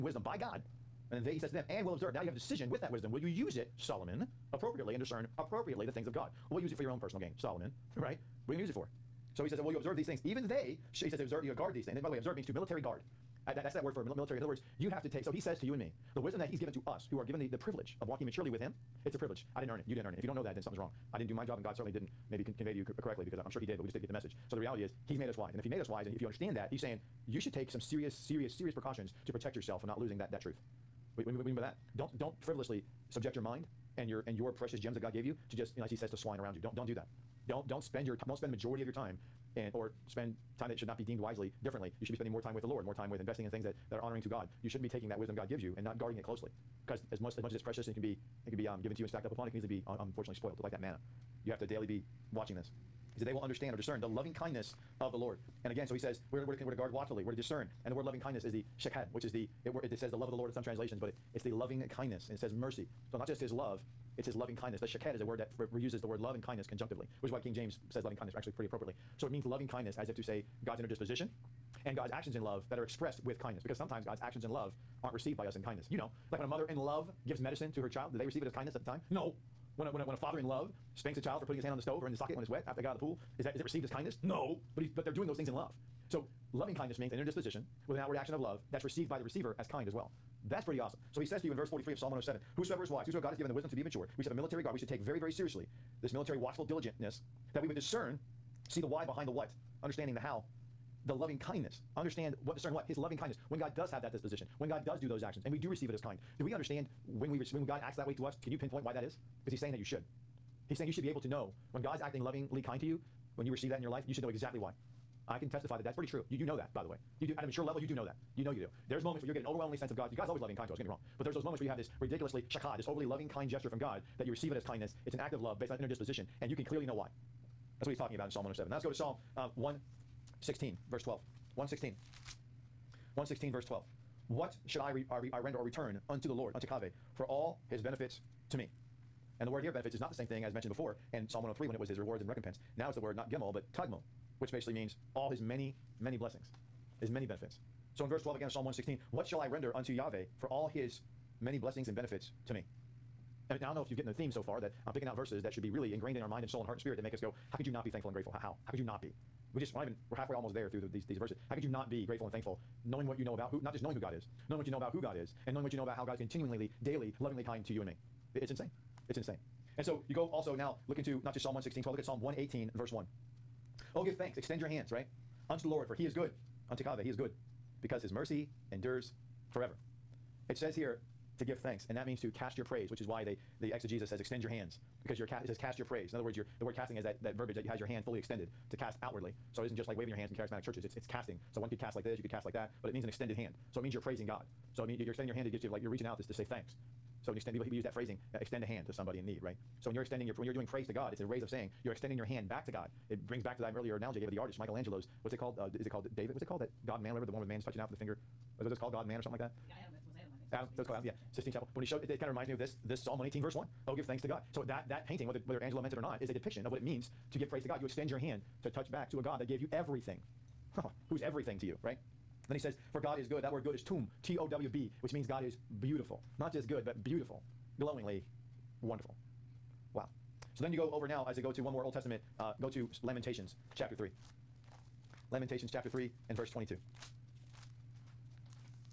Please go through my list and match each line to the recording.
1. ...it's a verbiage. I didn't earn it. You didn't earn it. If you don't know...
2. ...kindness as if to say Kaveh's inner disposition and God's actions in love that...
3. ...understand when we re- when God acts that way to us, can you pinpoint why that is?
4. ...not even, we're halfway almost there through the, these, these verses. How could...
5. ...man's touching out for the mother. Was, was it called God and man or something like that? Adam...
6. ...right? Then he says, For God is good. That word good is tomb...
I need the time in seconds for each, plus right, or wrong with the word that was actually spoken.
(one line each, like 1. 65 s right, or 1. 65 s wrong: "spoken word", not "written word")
1. 19 s wrong: "privilege", not "verbiage"
2. 69 s wrong: "God", not "Kaveh"
3. 106 s right
4. 159 s right
5. 207 s wrong: "finger", not "mother"
6. 221 s right.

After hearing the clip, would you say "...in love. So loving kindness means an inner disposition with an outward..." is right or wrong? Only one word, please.
right.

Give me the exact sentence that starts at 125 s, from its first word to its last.
It's an act of love based on inner disposition, and you can clearly know why.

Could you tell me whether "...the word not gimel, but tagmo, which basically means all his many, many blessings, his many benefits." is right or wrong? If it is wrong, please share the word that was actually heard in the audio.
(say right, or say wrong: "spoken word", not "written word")
right.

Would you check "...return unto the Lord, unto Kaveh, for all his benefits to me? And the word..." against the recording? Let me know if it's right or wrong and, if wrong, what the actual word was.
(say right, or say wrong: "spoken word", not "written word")
right.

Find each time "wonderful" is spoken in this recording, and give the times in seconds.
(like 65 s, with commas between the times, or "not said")
228 s.